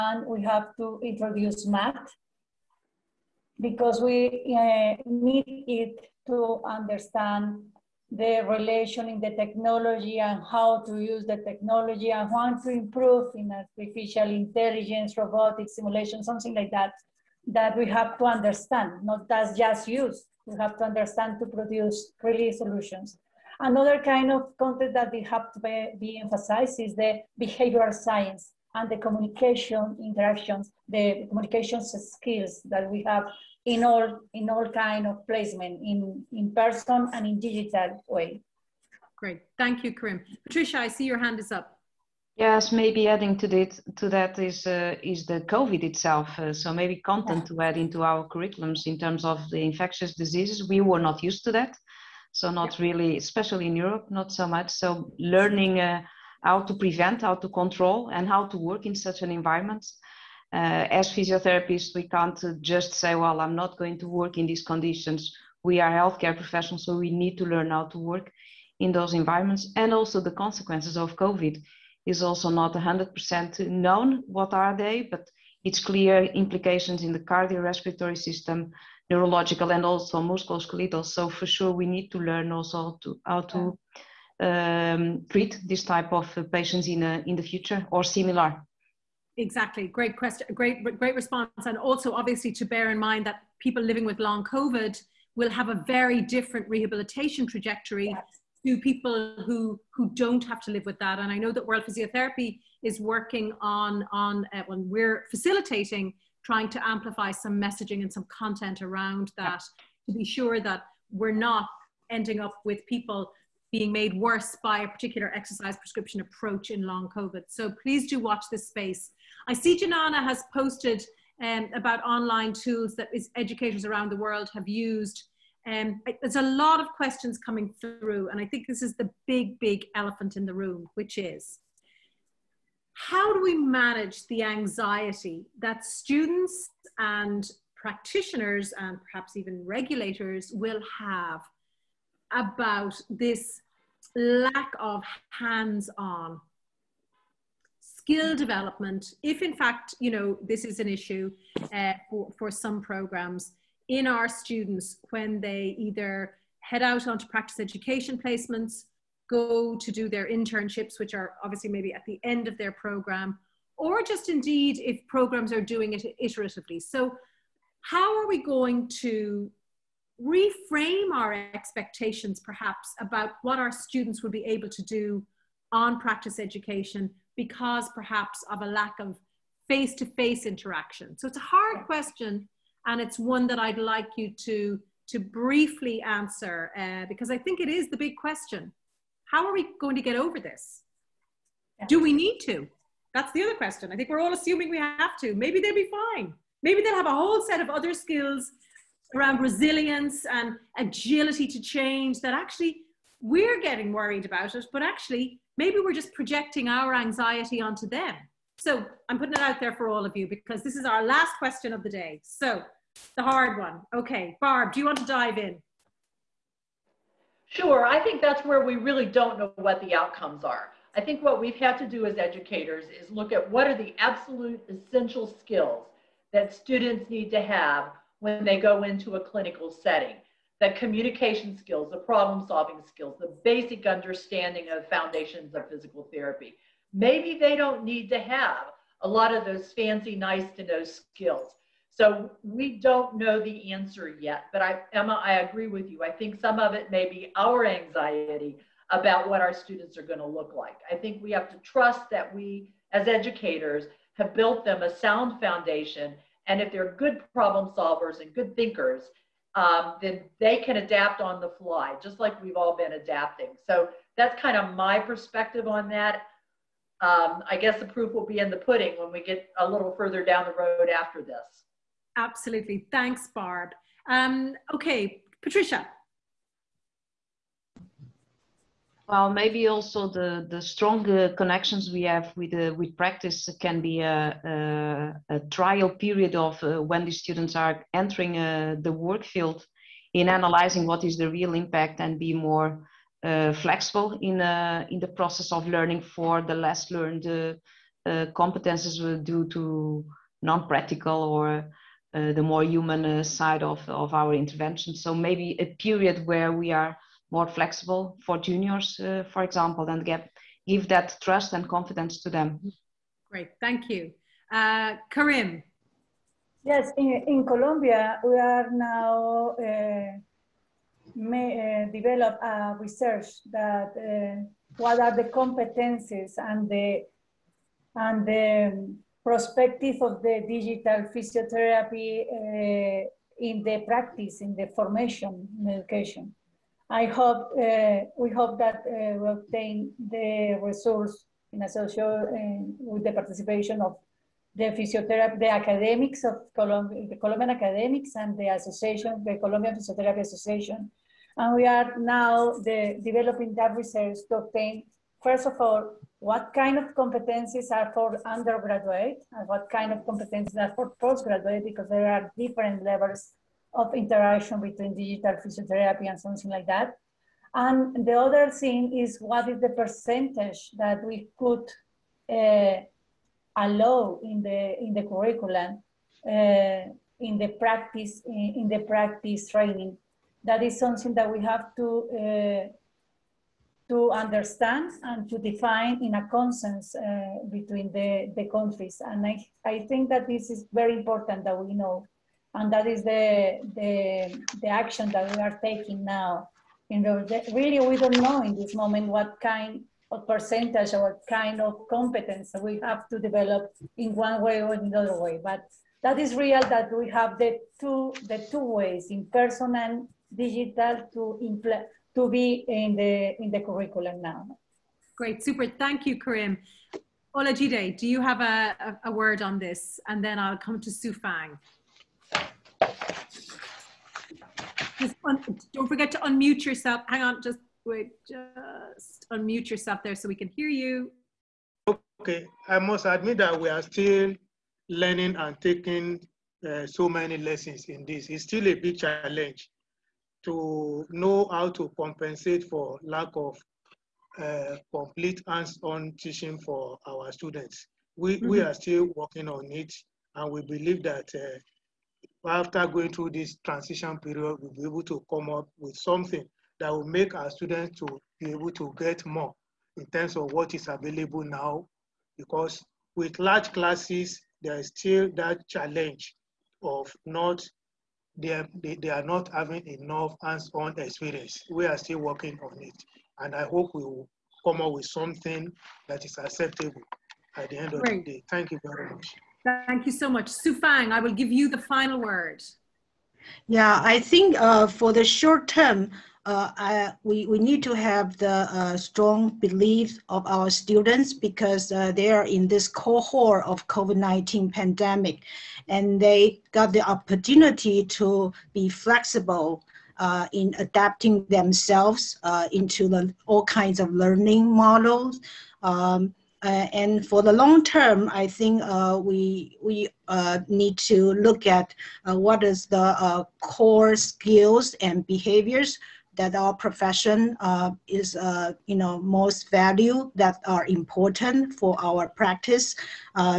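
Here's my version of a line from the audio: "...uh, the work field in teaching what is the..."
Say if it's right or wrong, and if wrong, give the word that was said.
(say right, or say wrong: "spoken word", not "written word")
wrong: "analyzing", not "teaching".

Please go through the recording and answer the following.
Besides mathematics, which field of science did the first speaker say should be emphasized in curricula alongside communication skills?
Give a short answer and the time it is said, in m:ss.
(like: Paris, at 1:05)
behavioral science, at 0:27.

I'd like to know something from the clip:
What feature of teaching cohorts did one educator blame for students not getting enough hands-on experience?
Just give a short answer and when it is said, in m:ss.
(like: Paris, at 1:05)
large classes, at 7:43.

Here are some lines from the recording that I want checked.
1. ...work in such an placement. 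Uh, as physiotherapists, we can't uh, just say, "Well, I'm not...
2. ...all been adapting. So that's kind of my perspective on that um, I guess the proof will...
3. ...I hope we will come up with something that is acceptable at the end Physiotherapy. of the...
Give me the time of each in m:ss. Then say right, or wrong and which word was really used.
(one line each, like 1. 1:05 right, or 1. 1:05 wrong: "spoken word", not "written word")
1. 0:58 wrong: "environment", not "placement"
2. 4:22 right
3. 7:53 wrong: "Great", not "Physiotherapy".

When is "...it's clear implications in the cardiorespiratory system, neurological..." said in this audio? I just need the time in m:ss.
1:15.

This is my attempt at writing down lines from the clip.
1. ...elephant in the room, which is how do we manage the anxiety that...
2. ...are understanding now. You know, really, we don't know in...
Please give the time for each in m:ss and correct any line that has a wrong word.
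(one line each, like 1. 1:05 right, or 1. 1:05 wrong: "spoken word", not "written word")
1. 2:09 right
2. 6:35 wrong: "taking", not "understanding".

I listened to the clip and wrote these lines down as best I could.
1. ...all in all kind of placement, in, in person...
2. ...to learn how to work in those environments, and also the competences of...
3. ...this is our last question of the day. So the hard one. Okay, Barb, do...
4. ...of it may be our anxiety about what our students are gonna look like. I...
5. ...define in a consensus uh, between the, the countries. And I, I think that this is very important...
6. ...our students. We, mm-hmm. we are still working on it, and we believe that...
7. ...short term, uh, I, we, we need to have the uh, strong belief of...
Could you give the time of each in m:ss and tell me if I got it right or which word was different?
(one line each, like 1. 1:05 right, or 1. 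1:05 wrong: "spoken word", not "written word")
1. 0:33 right
2. 1:07 wrong: "consequences", not "competences"
3. 3:30 right
4. 4:06 right
5. 6:25 right
6. 7:27 right
7. 8:05 right.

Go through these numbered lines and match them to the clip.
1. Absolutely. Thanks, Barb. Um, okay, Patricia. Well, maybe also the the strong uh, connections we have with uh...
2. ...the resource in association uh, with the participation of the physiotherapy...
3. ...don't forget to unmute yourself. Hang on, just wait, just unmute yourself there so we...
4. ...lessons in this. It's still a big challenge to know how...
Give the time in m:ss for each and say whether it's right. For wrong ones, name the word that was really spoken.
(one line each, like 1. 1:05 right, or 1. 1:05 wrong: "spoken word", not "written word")
1. 4:32 right
2. 5:39 right
3. 7:05 right
4. 7:17 right.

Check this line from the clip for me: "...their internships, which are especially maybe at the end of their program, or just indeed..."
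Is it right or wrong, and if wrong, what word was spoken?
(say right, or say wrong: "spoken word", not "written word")
wrong: "obviously", not "especially".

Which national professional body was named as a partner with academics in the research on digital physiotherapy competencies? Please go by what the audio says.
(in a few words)
Colombian Physiotherapy Association.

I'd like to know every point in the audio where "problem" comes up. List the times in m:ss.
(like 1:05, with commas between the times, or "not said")
3:51, 4:17.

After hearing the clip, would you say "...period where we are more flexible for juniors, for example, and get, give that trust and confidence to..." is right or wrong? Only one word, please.
right.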